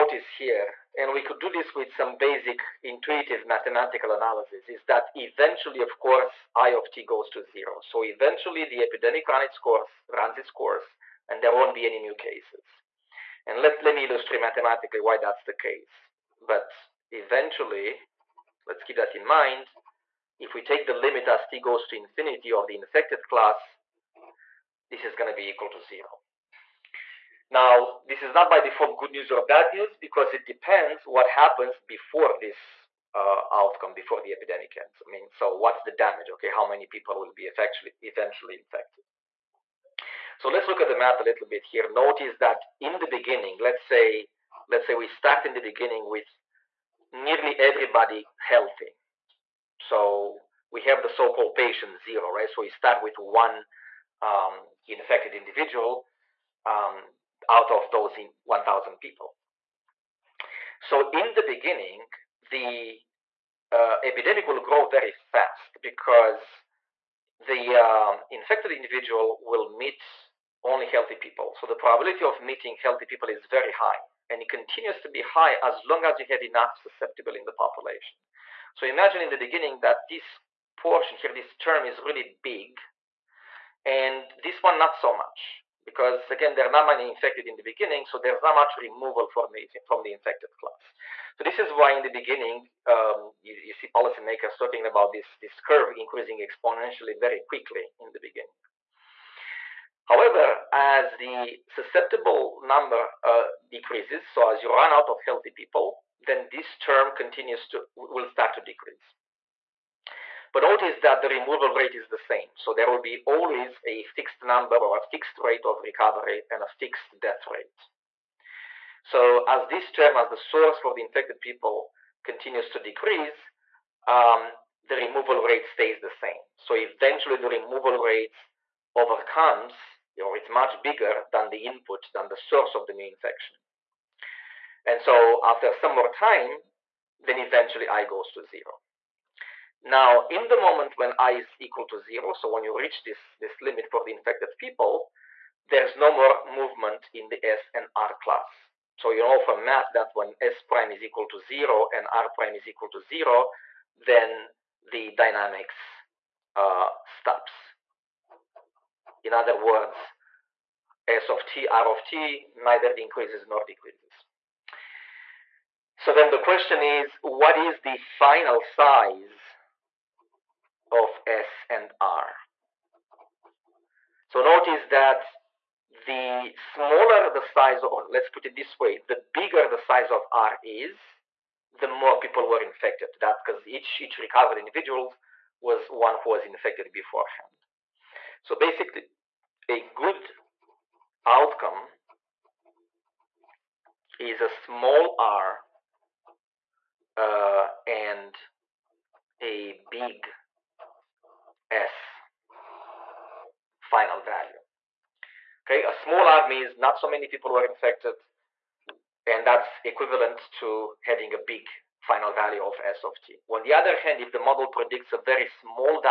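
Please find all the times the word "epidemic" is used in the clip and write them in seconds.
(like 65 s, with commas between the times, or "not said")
8 s, 34 s, 64 s.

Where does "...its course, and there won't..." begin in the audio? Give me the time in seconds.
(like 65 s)
10 s.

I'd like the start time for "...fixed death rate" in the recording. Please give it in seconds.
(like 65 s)
116 s.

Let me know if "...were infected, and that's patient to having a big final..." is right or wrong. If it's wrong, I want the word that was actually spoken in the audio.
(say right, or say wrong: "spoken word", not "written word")
wrong: "equivalent", not "patient".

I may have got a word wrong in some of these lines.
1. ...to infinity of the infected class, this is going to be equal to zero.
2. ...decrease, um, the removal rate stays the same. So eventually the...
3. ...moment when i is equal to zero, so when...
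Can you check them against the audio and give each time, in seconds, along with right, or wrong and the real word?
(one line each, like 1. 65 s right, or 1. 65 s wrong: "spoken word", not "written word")
1. 21 s right
2. 122 s right
3. 140 s right.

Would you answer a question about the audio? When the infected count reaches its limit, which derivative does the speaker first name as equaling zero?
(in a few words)
S prime.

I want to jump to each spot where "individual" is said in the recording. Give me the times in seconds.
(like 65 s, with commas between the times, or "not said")
55 s, 68 s, 184 s.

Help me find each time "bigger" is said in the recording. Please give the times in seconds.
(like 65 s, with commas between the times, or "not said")
130 s, 179 s.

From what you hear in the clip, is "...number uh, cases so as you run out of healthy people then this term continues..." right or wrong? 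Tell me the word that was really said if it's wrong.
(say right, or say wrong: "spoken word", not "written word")
wrong: "decreases", not "cases".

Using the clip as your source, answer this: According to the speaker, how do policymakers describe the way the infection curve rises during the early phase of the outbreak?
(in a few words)
exponentially.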